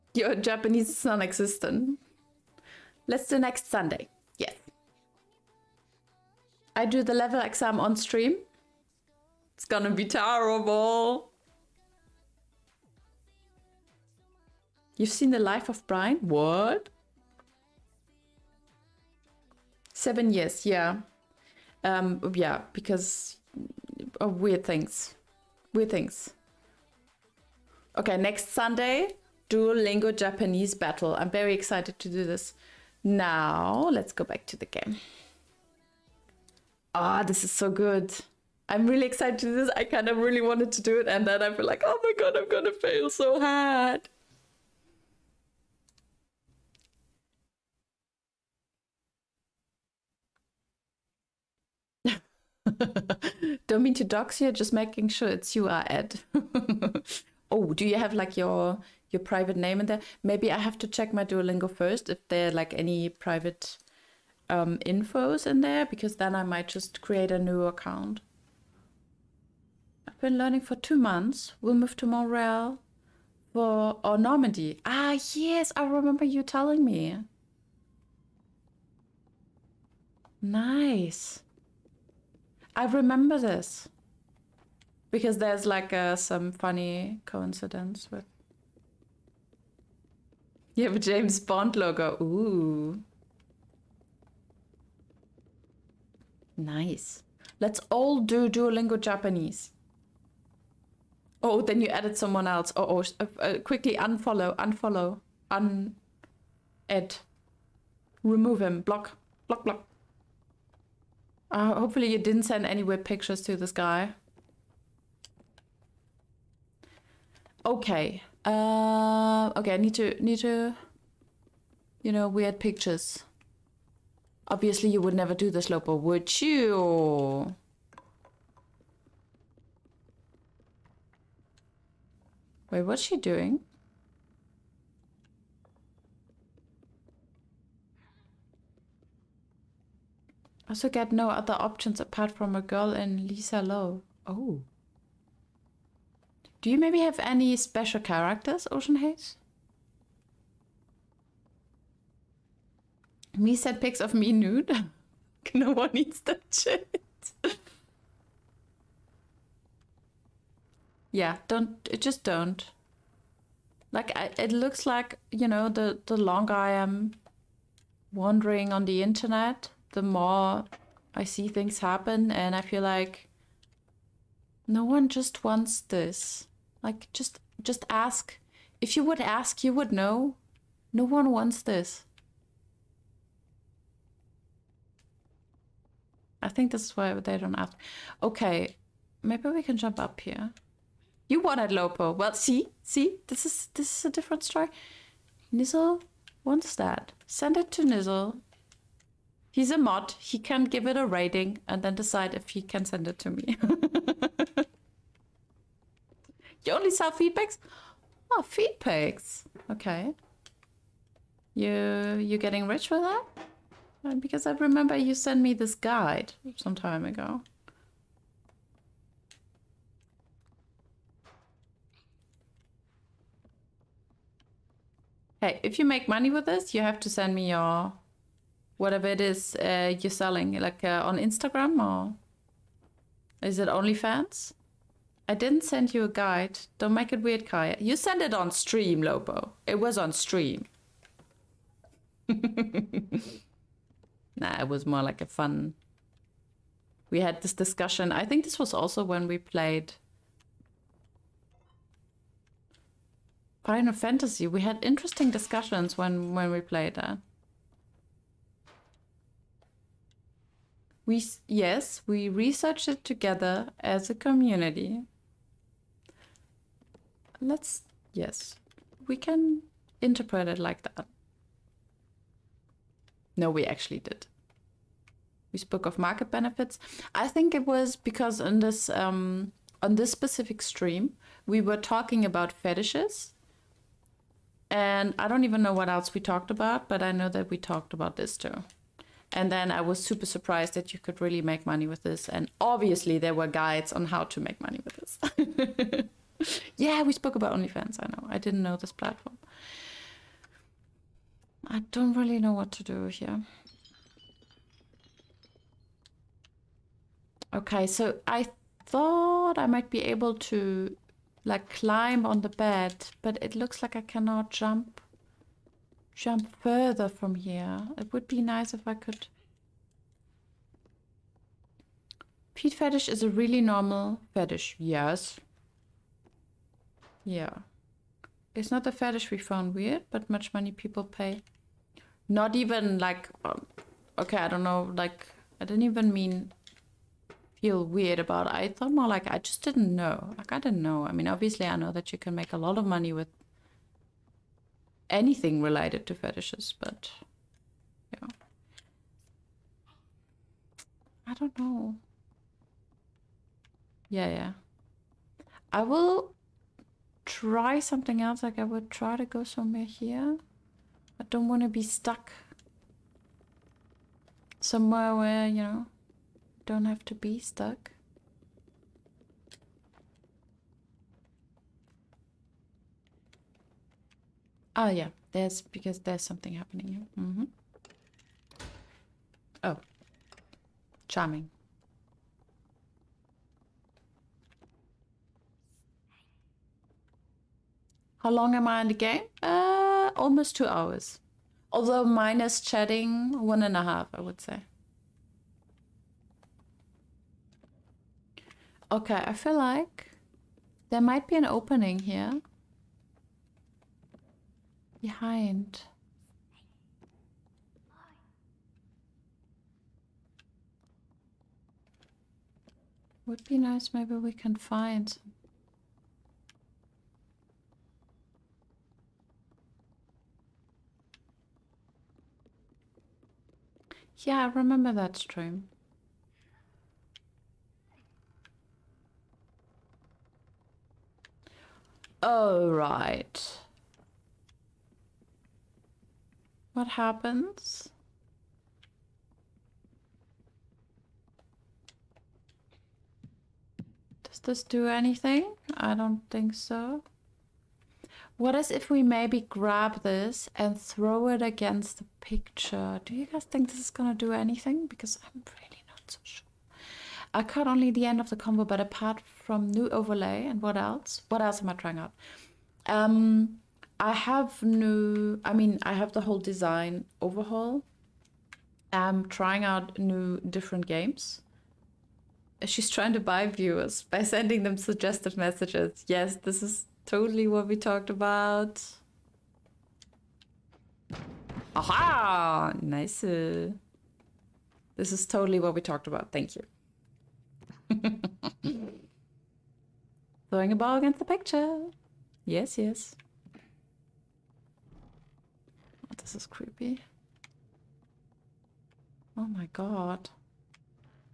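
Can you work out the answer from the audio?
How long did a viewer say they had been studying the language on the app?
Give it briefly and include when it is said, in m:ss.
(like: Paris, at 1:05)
2 months, at 1:10.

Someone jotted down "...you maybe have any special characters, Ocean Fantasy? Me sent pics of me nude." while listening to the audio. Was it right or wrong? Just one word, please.
wrong.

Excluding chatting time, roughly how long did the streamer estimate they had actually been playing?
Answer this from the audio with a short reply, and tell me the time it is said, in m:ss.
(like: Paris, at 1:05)
1.5 hours, at 6:33.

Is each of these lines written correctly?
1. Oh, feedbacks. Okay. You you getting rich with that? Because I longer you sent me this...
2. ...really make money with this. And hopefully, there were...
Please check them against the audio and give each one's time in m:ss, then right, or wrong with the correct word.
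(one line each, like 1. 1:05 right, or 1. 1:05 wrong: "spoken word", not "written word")
1. 3:28 wrong: "remember", not "longer"
2. 4:51 wrong: "obviously", not "hopefully".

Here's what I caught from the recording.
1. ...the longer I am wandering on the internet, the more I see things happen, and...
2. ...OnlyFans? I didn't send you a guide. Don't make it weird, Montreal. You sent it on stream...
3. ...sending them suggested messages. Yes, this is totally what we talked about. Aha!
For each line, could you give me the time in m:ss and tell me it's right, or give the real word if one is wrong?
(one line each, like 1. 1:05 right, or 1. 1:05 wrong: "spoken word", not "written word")
1. 2:46 right
2. 3:53 wrong: "Kaja", not "Montreal"
3. 7:54 right.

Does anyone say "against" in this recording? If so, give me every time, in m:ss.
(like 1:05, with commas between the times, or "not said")
7:31, 8:10.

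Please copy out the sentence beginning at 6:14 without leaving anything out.
Oh yeah, there's because there's something happening here.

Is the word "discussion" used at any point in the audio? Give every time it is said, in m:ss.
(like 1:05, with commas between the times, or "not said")
4:07, 4:15.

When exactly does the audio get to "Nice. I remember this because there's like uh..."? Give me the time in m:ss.
1:20.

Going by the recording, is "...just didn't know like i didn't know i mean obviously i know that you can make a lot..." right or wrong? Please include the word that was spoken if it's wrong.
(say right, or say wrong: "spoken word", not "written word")
right.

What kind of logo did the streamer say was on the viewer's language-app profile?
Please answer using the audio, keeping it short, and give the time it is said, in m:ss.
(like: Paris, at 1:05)
James Bond logo, at 1:30.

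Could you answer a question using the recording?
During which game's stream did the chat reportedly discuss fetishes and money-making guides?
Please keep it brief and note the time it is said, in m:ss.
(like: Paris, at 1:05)
Final Fantasy, at 4:13.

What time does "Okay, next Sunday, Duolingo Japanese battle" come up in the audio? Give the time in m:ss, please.
0:27.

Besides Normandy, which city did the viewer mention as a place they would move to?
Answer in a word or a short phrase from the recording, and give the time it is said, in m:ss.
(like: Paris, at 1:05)
Montreal, at 1:12.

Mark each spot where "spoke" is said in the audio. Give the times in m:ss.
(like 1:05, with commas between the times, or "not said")
4:35, 4:57.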